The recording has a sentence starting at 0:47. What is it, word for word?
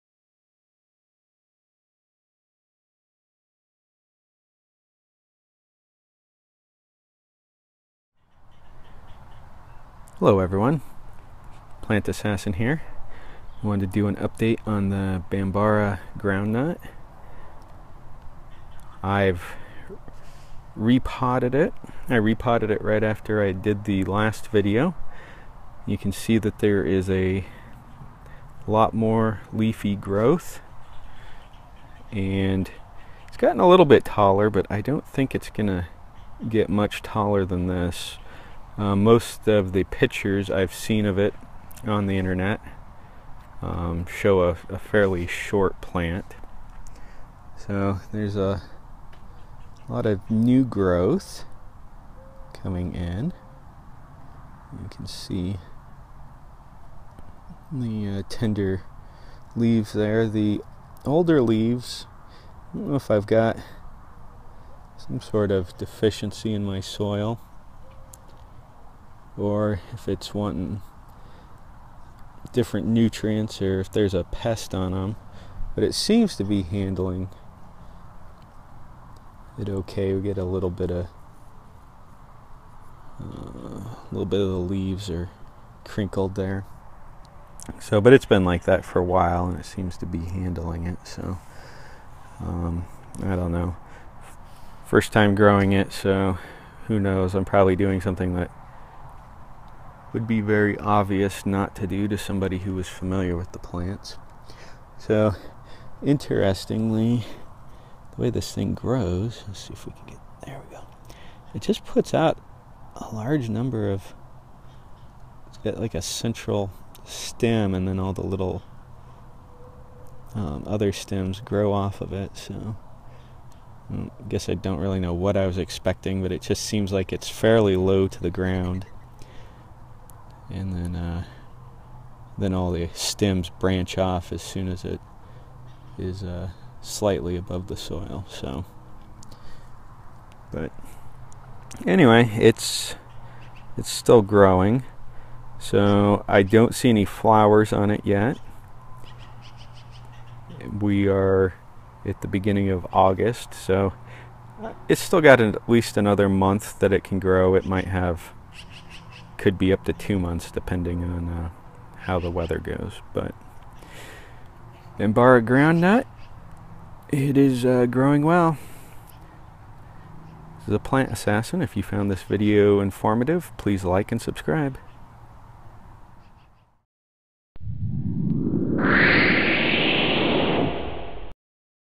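So there's a lot of new growth coming in.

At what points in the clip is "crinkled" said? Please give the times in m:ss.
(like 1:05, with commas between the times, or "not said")
1:25.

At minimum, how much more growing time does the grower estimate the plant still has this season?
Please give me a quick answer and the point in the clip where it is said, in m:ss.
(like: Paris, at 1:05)
1 month, at 2:35.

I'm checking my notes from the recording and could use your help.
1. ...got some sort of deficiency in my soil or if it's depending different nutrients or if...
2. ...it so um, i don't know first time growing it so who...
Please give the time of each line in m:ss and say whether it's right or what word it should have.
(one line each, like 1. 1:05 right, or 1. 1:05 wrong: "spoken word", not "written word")
1. 1:03 wrong: "wanting", not "depending"
2. 1:30 right.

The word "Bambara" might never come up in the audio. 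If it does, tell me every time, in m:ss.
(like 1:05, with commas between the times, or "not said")
0:15, 2:44.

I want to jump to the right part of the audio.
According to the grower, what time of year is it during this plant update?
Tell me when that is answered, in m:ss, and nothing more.
2:32.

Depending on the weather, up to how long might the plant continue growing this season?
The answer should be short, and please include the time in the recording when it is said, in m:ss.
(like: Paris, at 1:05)
2 months, at 2:39.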